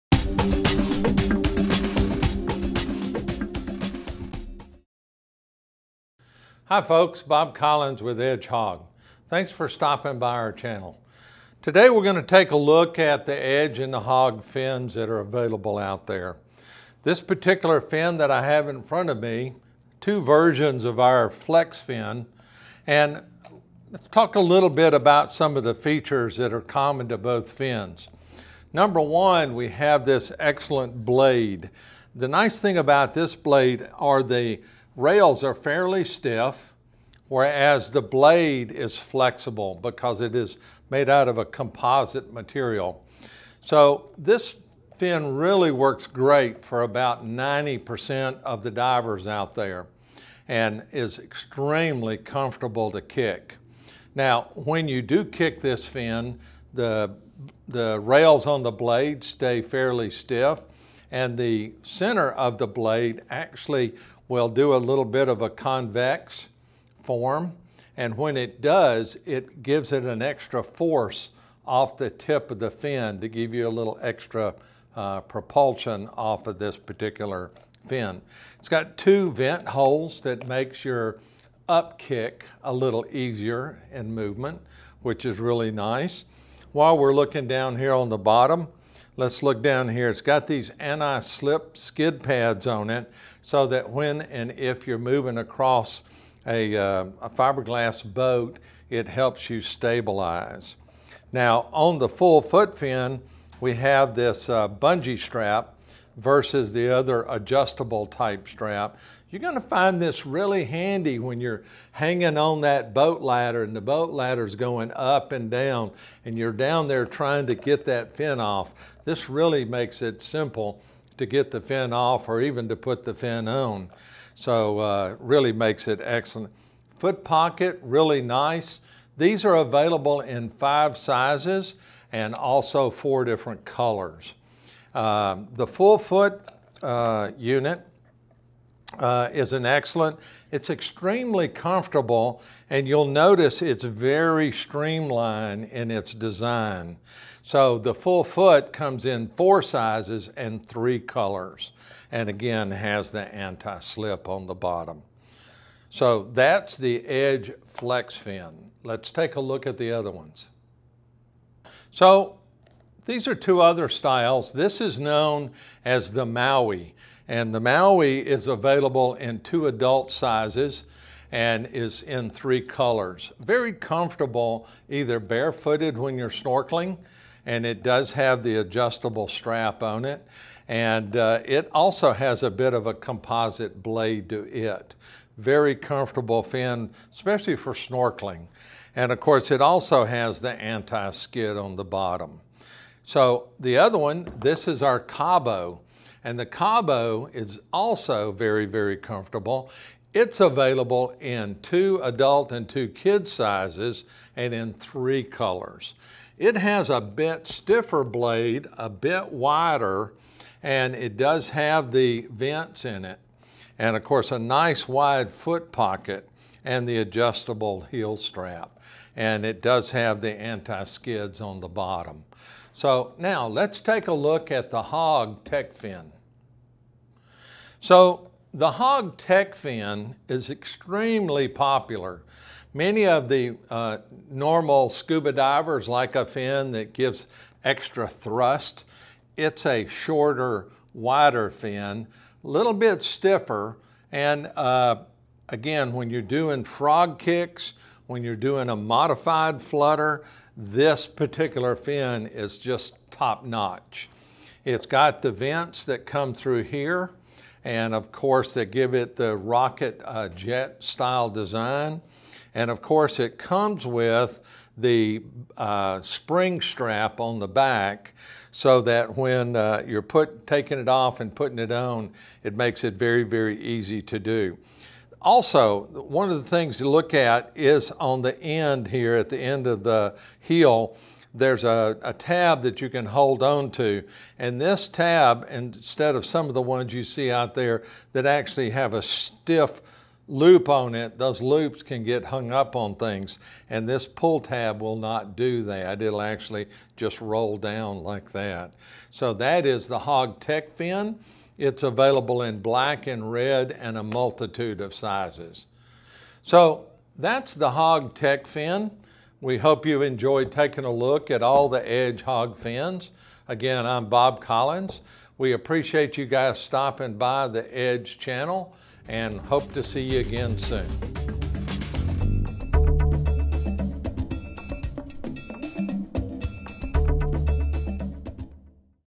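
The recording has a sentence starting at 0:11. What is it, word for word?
Today we're going to take a look at the edge and the hog fins that are available out there.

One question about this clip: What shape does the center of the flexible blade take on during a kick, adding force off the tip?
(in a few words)
convex.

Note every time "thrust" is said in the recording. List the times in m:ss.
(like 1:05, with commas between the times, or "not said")
3:58.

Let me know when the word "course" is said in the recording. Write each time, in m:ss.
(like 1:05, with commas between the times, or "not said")
3:09, 3:34, 4:18, 4:22.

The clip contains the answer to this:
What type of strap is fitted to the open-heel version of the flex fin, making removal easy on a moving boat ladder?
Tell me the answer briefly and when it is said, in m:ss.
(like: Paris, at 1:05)
bungee strap, at 1:44.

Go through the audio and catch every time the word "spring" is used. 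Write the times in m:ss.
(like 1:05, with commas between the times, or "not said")
4:26.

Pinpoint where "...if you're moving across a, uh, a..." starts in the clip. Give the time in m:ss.
1:34.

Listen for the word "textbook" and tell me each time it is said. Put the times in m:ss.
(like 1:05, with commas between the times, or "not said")
not said.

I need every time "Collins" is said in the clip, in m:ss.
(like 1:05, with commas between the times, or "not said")
0:07, 5:14.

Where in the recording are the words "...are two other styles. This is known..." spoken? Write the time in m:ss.
2:43.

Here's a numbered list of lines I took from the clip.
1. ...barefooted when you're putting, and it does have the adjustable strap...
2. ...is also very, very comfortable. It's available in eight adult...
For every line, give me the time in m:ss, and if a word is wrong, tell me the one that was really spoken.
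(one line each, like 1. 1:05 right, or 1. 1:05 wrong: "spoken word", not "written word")
1. 2:55 wrong: "snorkeling", not "putting"
2. 3:17 wrong: "two", not "eight".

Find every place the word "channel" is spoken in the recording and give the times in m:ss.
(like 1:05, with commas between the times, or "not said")
0:10, 5:18.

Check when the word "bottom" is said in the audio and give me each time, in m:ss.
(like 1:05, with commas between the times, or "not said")
1:28, 2:34, 3:11, 3:41.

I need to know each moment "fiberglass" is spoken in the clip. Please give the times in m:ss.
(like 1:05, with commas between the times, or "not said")
1:37.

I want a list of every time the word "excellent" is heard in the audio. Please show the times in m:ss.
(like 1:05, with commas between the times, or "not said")
0:30, 2:06, 2:19.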